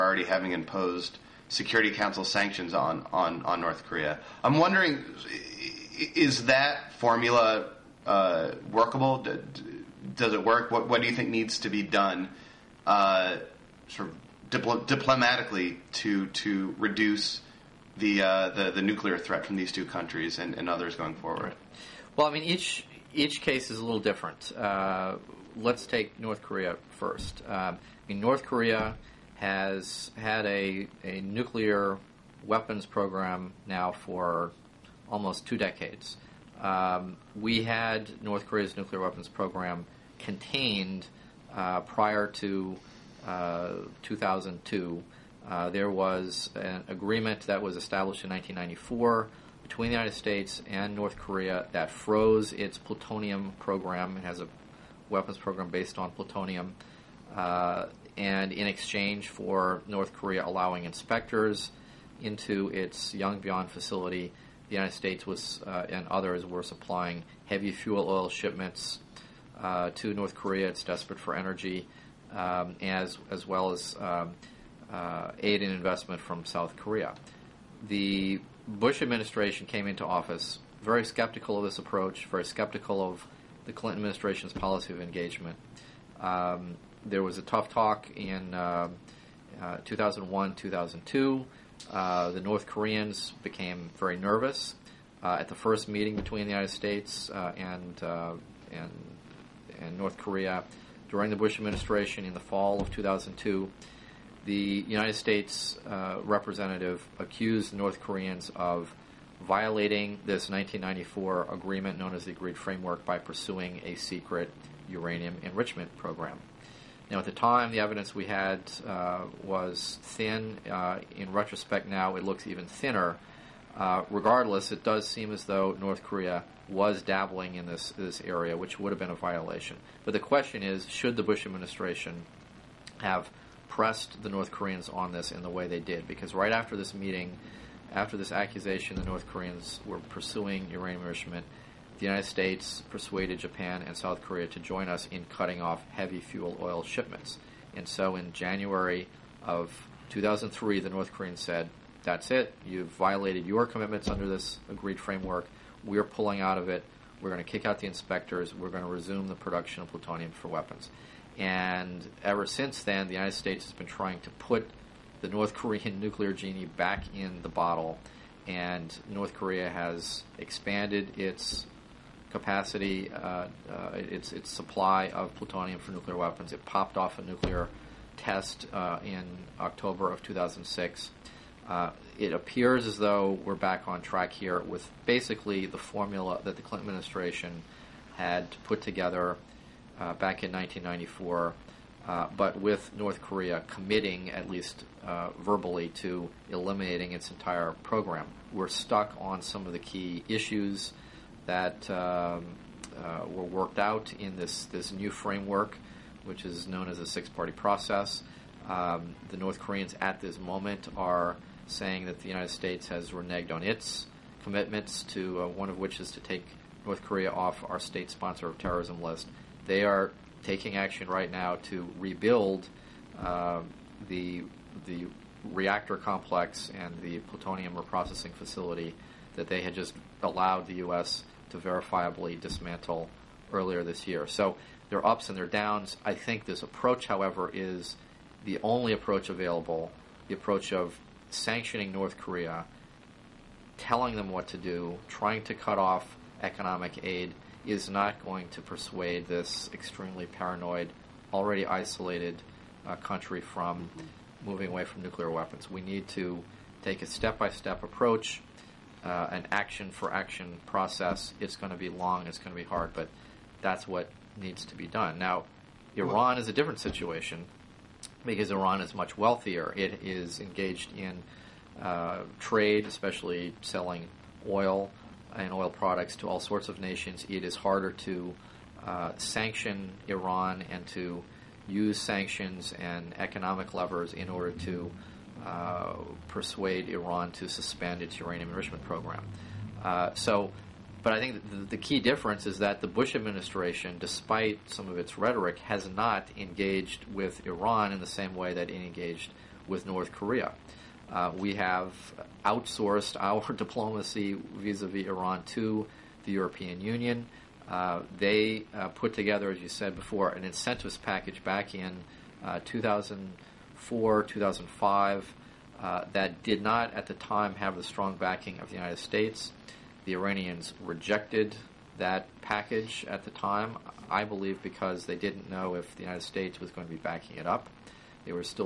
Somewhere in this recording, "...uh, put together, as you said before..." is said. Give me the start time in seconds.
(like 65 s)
308 s.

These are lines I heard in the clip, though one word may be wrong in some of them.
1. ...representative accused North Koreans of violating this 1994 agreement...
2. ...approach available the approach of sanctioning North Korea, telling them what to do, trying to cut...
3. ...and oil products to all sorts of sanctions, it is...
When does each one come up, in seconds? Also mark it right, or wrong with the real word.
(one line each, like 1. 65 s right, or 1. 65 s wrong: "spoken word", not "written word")
1. 106 s right
2. 238 s right
3. 275 s wrong: "nations", not "sanctions".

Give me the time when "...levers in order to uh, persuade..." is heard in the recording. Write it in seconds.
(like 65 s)
283 s.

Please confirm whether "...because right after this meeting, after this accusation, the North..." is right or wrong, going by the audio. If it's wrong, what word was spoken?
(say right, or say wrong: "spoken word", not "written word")
right.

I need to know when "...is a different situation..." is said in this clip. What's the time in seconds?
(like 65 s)
266 s.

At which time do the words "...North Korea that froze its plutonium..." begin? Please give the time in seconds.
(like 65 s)
50 s.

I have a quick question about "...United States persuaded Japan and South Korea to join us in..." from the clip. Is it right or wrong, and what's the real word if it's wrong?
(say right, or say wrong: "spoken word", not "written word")
right.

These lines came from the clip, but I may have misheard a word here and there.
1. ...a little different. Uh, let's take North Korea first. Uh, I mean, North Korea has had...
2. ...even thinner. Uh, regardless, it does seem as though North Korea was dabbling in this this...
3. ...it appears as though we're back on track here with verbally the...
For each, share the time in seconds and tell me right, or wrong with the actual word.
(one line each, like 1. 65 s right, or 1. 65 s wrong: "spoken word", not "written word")
1. 23 s right
2. 122 s right
3. 182 s wrong: "basically", not "verbally".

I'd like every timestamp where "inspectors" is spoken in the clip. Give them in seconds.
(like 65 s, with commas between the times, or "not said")
60 s, 157 s.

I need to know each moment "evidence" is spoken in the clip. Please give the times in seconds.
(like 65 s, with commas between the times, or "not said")
117 s.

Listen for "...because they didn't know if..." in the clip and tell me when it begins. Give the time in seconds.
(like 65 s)
324 s.